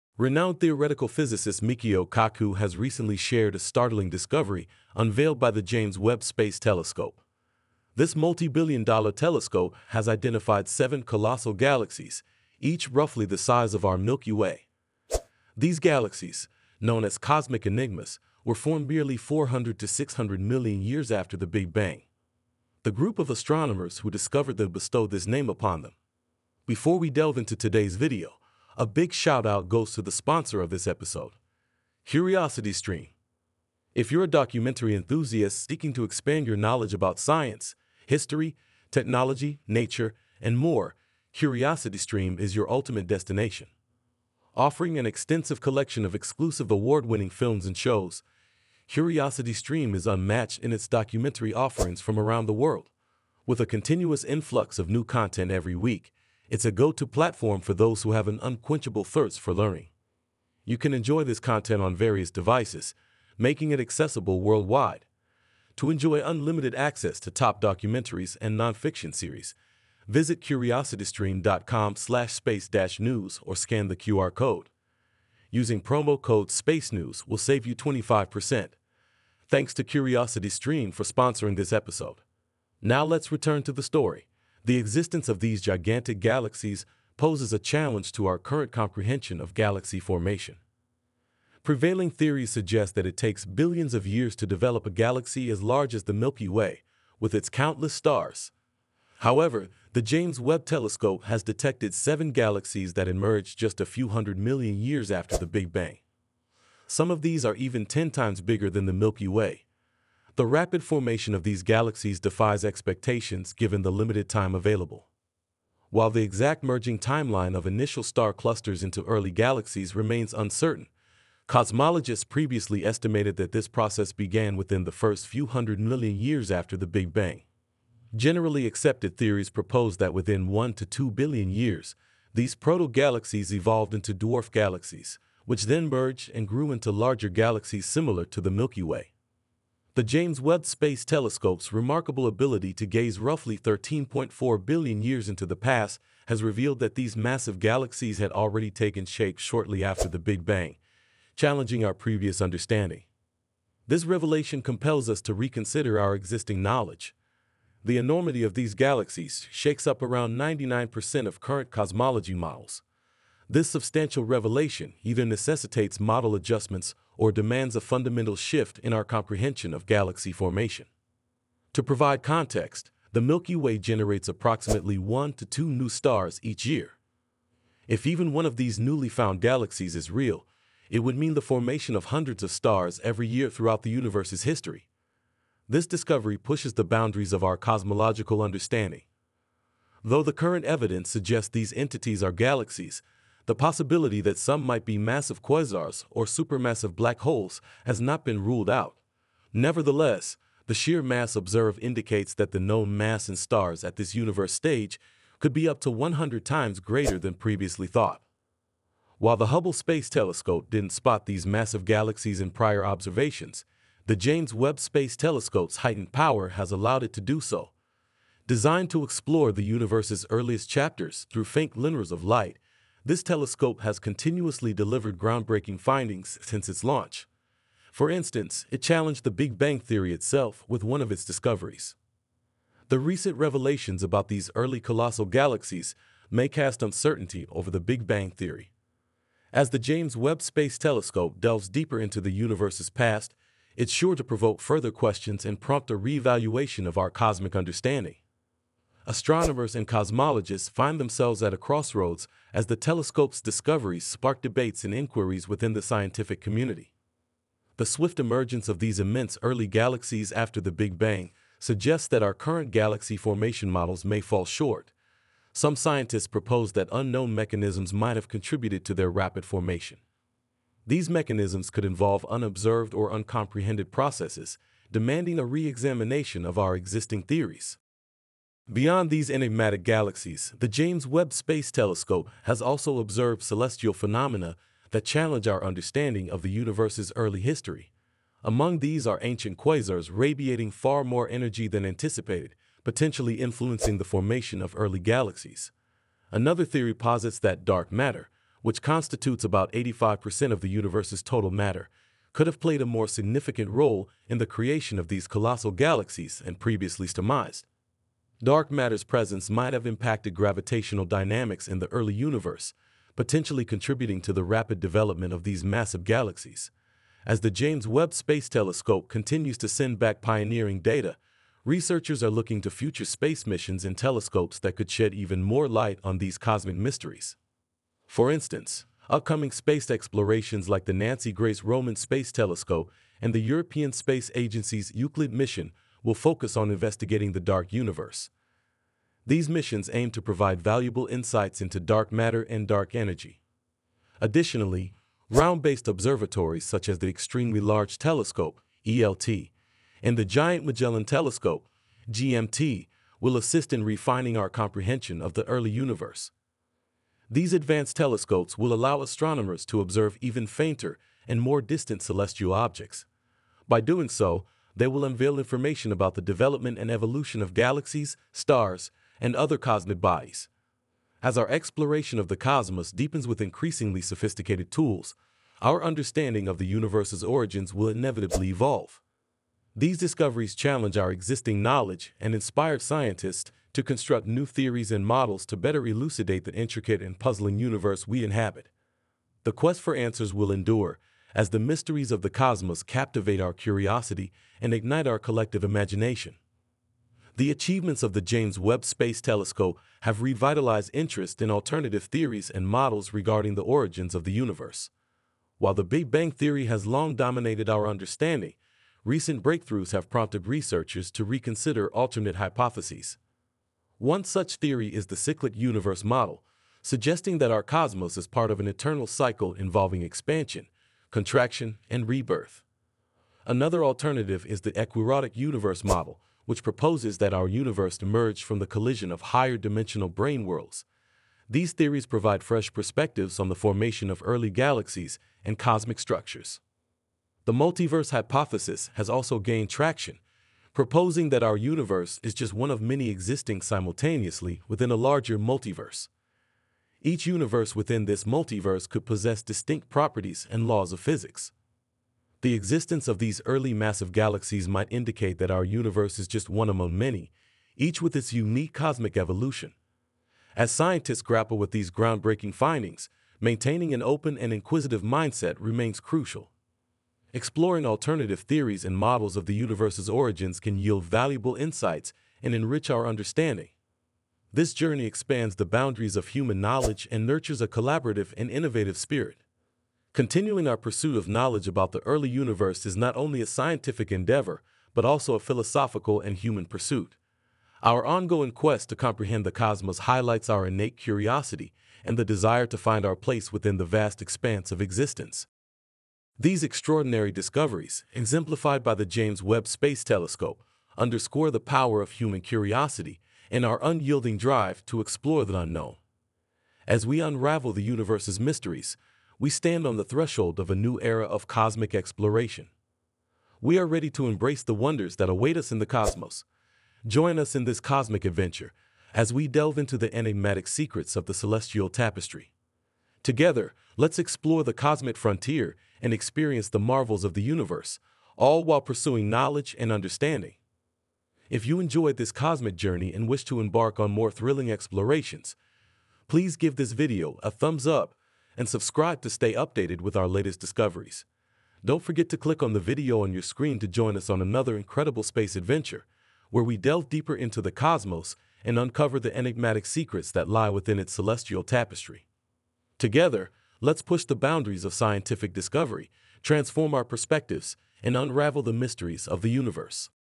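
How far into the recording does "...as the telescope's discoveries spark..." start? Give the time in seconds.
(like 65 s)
252 s.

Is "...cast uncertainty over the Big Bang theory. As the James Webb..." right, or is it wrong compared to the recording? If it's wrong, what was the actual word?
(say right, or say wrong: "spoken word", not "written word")
right.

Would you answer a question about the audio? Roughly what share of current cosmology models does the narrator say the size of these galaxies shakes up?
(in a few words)
99%.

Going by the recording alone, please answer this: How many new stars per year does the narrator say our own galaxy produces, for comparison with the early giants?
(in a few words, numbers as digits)
1 to 2.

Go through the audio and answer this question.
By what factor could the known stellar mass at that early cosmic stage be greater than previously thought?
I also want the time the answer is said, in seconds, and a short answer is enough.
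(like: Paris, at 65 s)
100 times, at 205 s.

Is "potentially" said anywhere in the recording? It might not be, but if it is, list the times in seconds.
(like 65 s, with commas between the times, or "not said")
292 s, 313 s.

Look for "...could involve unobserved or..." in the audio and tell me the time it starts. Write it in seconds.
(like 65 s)
271 s.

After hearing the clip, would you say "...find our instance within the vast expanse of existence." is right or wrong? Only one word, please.
wrong.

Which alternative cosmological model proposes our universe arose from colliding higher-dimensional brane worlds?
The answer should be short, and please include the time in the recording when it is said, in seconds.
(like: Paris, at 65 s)
Ekpyrotic universe model, at 424 s.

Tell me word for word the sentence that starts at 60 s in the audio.
You can enjoy this content on various devices, making it accessible worldwide.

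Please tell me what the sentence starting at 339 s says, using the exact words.
These missions aim to provide valuable insights into dark matter and dark energy.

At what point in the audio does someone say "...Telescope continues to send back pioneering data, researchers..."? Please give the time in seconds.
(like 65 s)
318 s.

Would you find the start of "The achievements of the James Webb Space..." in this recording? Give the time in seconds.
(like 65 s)
397 s.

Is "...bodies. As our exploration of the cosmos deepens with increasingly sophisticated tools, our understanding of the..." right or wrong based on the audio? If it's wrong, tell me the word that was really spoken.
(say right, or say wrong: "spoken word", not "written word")
right.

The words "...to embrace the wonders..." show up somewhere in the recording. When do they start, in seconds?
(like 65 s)
514 s.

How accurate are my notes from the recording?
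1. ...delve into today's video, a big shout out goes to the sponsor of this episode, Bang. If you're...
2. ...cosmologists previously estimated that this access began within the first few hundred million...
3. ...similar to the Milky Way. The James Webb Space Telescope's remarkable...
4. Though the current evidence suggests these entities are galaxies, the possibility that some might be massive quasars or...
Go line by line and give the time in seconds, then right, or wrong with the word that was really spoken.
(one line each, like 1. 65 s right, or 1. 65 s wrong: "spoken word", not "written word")
1. 27 s wrong: "CuriosityStream", not "Bang"
2. 121 s wrong: "process", not "access"
3. 137 s right
4. 190 s right.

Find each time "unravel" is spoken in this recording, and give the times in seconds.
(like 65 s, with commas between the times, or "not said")
507 s, 558 s.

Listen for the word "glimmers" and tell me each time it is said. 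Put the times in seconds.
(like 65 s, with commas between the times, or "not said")
221 s.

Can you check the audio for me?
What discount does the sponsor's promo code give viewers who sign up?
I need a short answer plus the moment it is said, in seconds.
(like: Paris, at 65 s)
25%, at 77 s.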